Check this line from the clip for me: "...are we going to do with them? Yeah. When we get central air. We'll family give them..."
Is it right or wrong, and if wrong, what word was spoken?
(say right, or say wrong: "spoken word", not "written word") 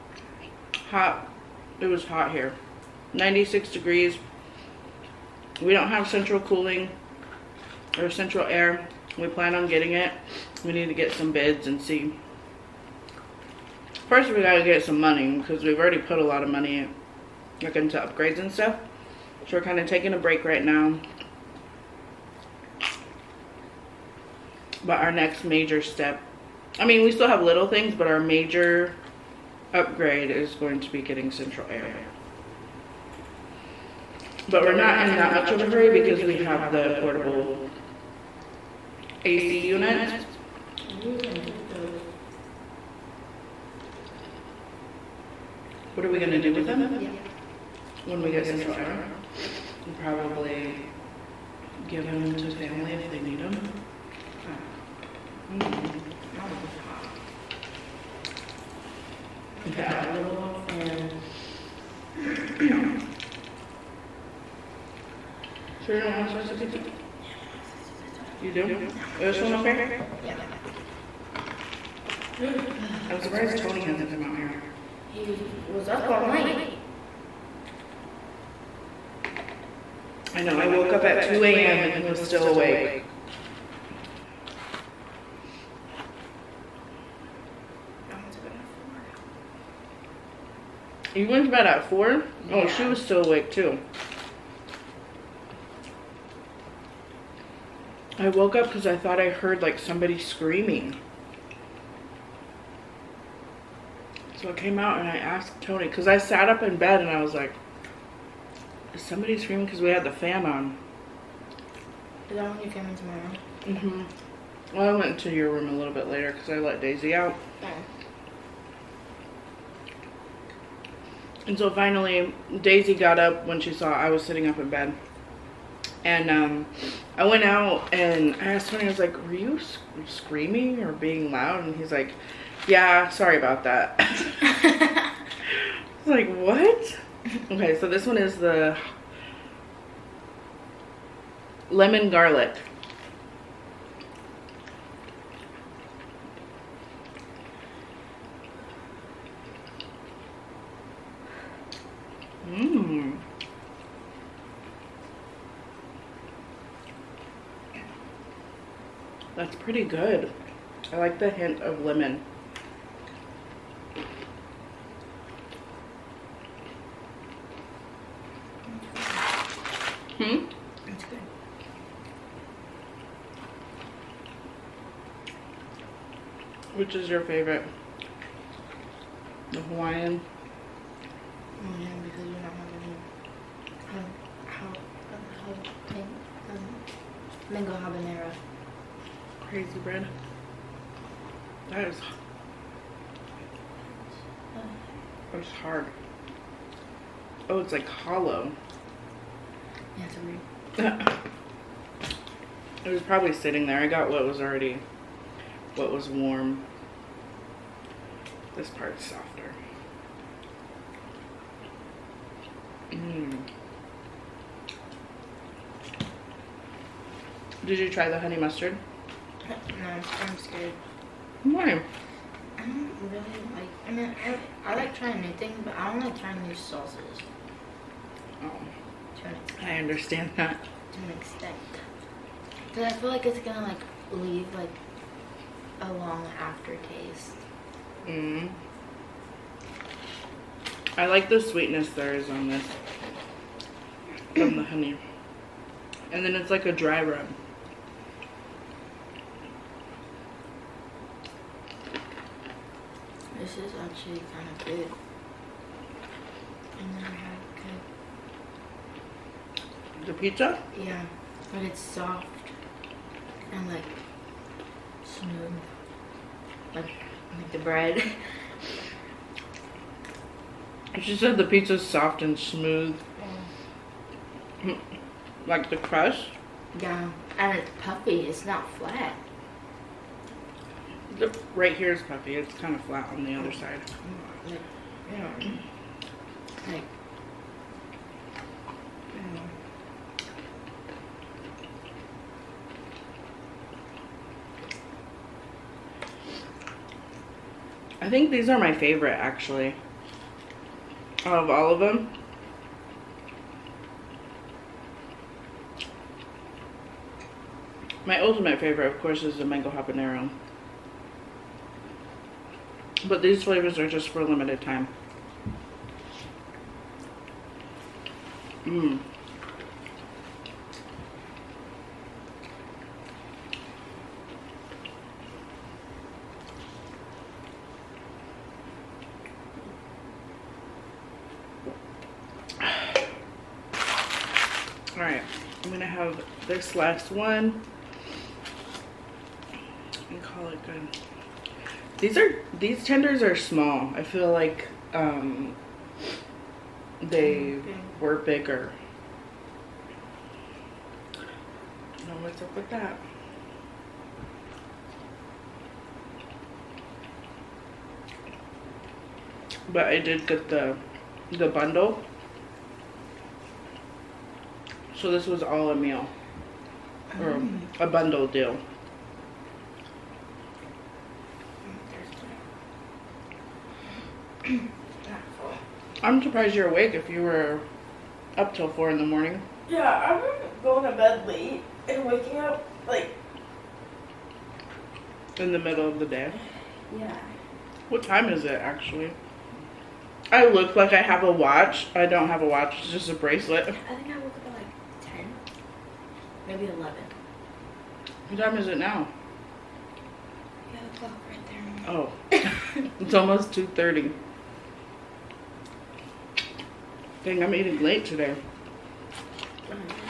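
wrong: "probably", not "family".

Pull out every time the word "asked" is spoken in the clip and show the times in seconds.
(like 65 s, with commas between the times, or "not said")
105 s, 128 s.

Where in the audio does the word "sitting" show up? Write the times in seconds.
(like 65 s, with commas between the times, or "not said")
124 s, 203 s.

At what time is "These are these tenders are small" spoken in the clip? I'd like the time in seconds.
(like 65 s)
341 s.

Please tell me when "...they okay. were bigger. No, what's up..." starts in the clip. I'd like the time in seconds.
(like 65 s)
347 s.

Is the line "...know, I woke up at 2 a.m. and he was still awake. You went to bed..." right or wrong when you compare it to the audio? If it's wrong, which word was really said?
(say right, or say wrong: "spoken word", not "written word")
right.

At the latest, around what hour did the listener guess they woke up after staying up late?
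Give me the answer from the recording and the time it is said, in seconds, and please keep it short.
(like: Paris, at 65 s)
11, at 396 s.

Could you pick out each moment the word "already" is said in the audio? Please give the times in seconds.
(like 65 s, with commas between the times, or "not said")
15 s, 204 s.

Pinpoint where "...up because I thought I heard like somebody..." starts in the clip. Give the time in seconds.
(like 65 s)
98 s.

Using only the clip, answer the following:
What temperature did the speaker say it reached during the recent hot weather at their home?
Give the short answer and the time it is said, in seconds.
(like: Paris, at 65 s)
96 degrees, at 3 s.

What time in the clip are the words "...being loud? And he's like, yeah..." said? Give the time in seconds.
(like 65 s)
130 s.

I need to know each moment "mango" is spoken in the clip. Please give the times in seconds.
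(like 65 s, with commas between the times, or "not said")
187 s, 309 s.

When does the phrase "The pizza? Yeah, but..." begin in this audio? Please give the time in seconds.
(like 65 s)
260 s.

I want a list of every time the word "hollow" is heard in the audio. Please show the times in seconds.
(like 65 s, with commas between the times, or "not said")
197 s.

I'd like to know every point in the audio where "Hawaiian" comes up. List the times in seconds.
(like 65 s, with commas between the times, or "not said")
179 s.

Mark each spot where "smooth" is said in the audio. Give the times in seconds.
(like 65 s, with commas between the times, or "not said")
265 s, 272 s.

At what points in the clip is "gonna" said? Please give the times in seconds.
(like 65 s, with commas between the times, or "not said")
233 s, 335 s.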